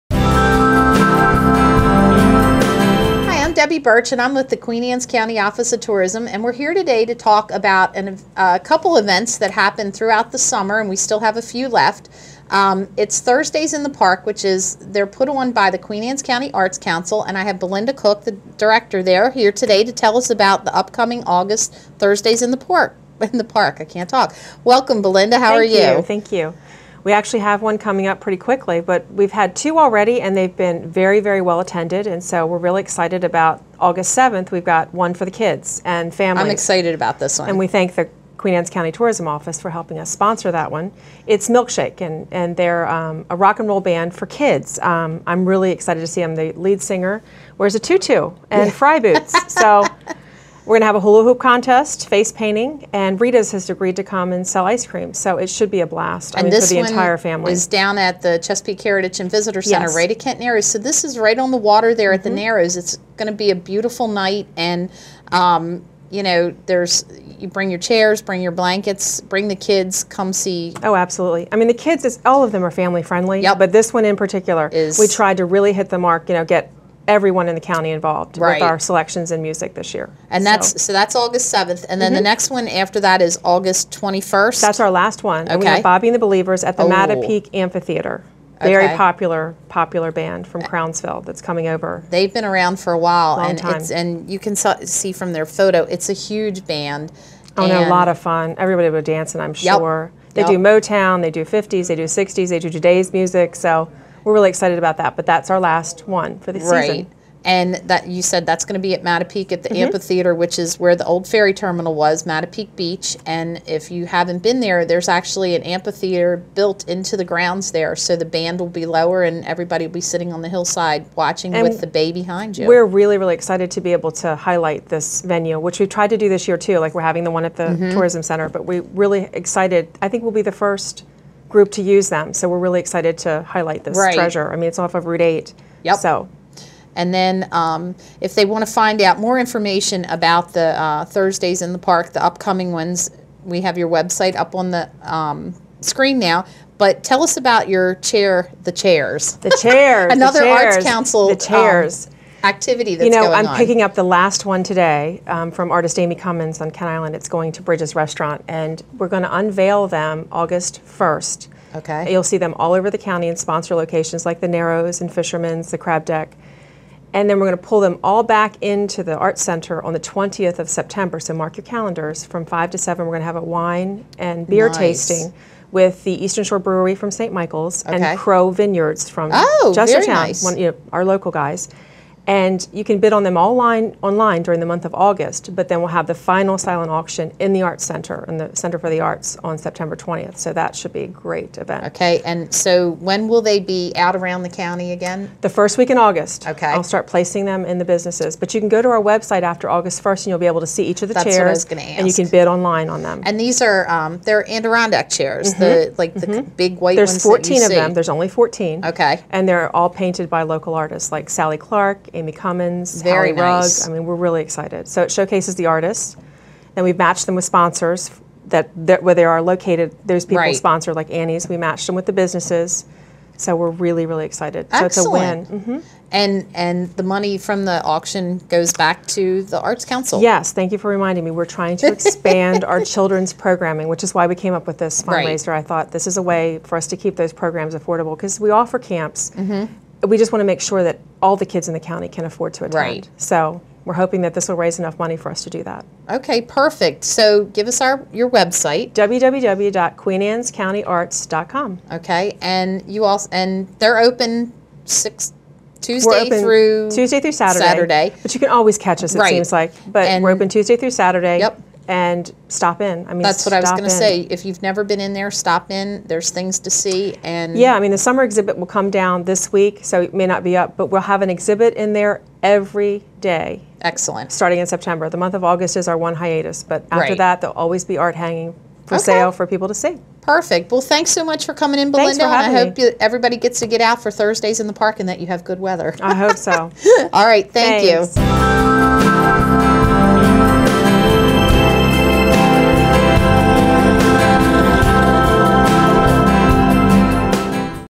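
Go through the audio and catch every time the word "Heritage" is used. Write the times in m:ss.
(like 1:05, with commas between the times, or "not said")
0:58.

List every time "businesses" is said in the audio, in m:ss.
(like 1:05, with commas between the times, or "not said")
3:17, 3:42.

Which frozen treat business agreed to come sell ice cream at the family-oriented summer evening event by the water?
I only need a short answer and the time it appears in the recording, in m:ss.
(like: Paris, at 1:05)
Rita's, at 0:53.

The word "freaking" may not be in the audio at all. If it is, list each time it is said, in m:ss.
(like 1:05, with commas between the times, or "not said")
not said.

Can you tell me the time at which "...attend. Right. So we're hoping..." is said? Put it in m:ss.
4:02.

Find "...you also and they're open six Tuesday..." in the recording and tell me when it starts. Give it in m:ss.
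4:12.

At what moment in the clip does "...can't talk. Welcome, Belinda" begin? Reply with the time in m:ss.
0:23.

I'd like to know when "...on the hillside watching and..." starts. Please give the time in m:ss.
2:00.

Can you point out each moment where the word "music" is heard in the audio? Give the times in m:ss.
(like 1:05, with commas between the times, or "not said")
1:19, 1:43.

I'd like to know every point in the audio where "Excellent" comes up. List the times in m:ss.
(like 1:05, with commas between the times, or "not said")
3:44, 4:33.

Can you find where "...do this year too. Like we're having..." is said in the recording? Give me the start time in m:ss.
2:06.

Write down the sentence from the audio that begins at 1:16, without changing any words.
You know, get everyone in the county involved right.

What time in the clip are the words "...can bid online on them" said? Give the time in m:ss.
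3:22.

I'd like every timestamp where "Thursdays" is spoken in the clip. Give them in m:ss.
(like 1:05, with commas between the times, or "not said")
0:13, 0:21, 2:21, 4:44.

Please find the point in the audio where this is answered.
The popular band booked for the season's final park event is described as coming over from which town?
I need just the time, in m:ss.
1:30.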